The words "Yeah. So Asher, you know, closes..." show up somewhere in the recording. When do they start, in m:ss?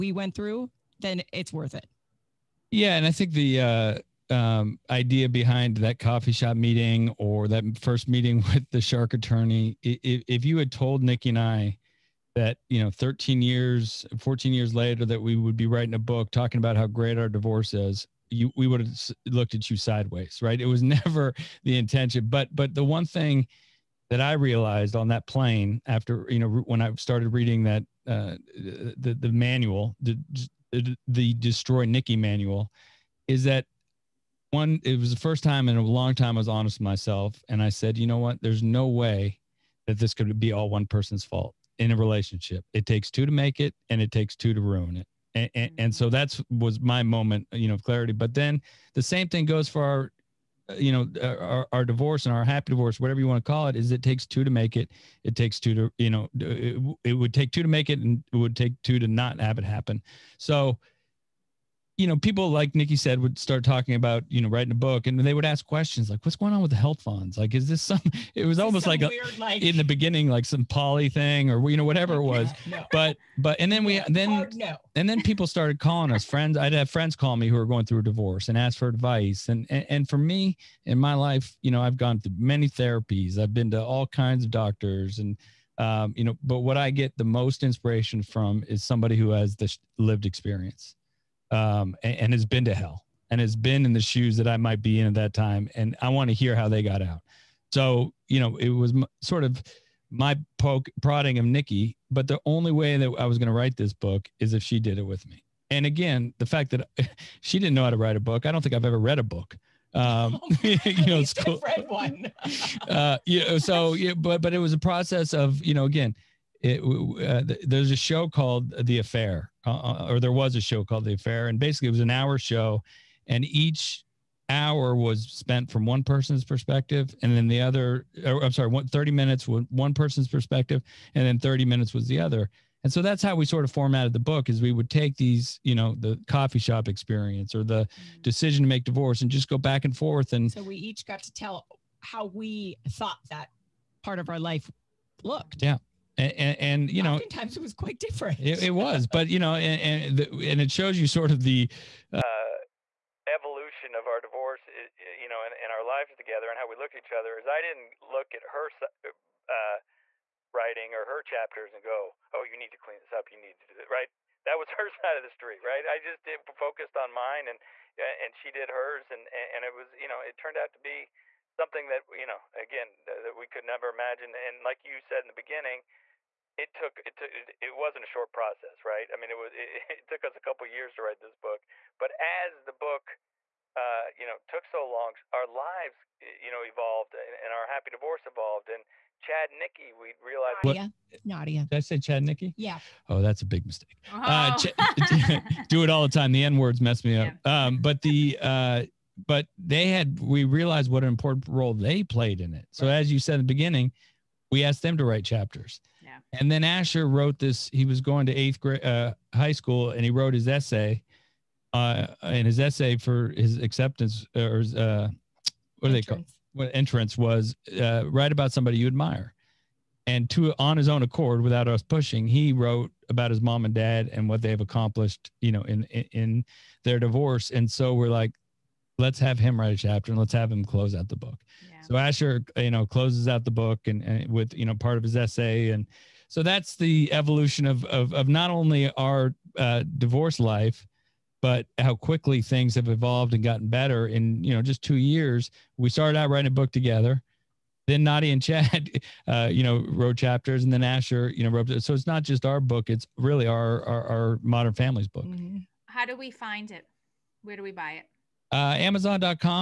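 3:51.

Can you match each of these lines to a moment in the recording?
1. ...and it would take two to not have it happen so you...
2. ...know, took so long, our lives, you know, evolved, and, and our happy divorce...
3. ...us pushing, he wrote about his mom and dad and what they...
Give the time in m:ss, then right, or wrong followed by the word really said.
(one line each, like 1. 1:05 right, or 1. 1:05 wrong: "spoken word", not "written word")
1. 0:58 right
2. 3:04 right
3. 3:41 right.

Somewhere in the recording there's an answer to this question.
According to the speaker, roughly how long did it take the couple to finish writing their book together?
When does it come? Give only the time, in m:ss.
3:00.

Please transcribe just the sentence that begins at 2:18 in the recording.
decision to make divorce and just go back and forth.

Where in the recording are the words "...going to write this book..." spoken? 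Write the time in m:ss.
1:43.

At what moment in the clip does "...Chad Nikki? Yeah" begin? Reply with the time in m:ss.
3:11.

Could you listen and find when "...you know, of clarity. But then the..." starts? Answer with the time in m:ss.
0:47.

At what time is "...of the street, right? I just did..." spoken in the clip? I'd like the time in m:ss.
2:45.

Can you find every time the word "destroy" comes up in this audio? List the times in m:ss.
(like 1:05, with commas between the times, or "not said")
0:31.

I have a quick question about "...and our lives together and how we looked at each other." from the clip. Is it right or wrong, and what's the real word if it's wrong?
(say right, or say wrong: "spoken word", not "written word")
right.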